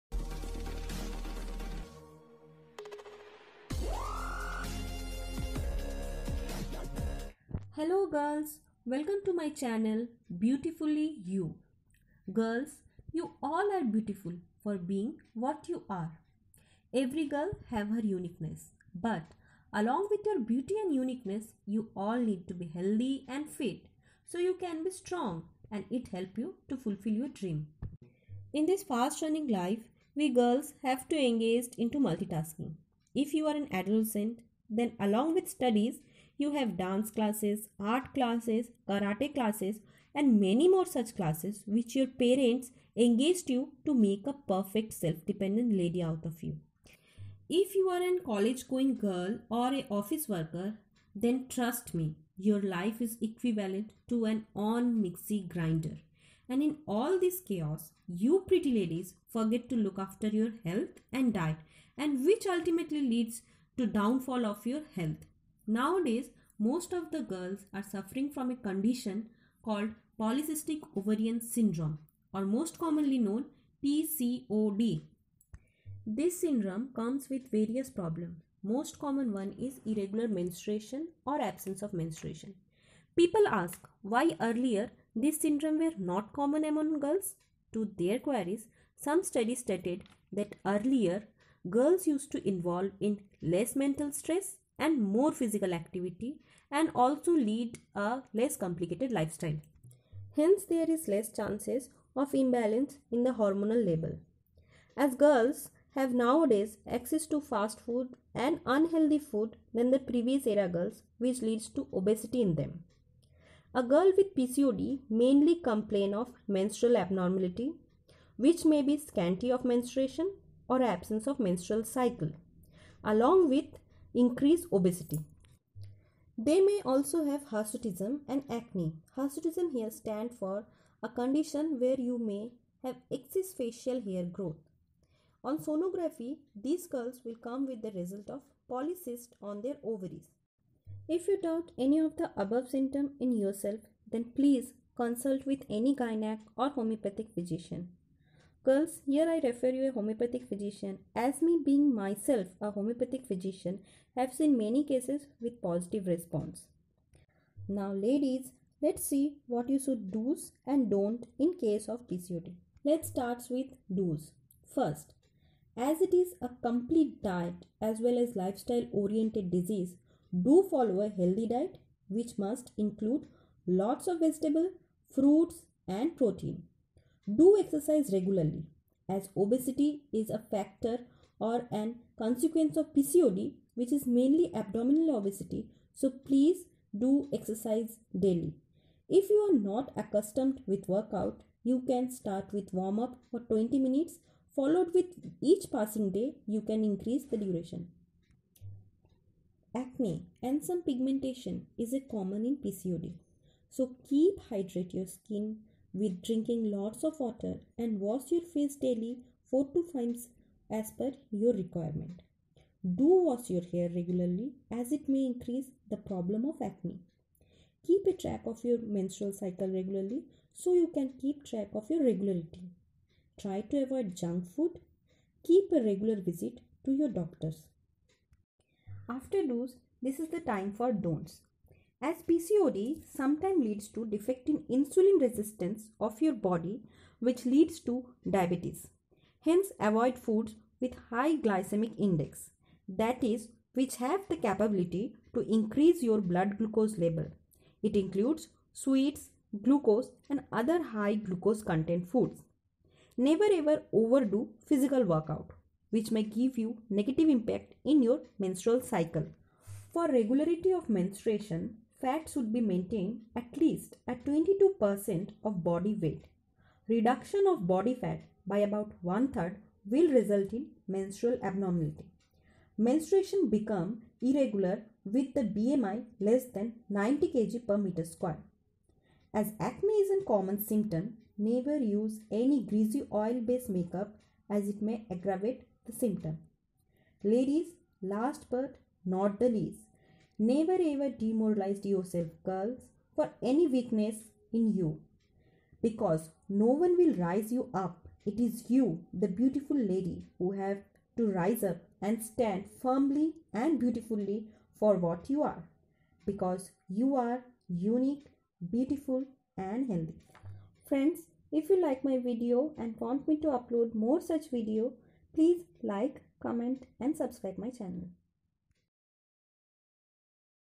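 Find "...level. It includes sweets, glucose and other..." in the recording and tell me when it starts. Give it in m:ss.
4:06.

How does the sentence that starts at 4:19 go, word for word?
For regularity of menstruation, fat should be maintained at least at 22% of body weight.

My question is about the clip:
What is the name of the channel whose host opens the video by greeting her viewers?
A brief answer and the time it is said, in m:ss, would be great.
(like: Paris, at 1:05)
Beautifully You, at 0:10.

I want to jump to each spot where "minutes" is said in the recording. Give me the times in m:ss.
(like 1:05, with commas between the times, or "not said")
3:13.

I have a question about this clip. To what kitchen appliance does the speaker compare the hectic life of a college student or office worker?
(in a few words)
mixie grinder.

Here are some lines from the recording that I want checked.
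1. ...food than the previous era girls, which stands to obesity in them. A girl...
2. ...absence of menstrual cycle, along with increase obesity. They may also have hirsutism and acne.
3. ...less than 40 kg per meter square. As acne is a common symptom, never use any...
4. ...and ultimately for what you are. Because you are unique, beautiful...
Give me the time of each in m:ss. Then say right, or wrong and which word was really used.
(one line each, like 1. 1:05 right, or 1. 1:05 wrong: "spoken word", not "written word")
1. 1:49 wrong: "leads", not "stands"
2. 2:00 right
3. 4:36 wrong: "90", not "40"
4. 5:03 wrong: "beautifully", not "ultimately".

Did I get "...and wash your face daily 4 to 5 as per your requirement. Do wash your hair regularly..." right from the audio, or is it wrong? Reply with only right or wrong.
right.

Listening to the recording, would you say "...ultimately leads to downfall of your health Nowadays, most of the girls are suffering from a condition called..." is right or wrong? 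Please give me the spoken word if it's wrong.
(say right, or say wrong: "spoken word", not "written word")
right.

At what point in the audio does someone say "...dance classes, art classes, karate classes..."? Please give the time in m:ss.
0:36.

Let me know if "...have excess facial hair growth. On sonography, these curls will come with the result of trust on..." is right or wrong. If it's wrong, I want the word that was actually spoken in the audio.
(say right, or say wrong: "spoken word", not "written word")
wrong: "polycyst", not "trust".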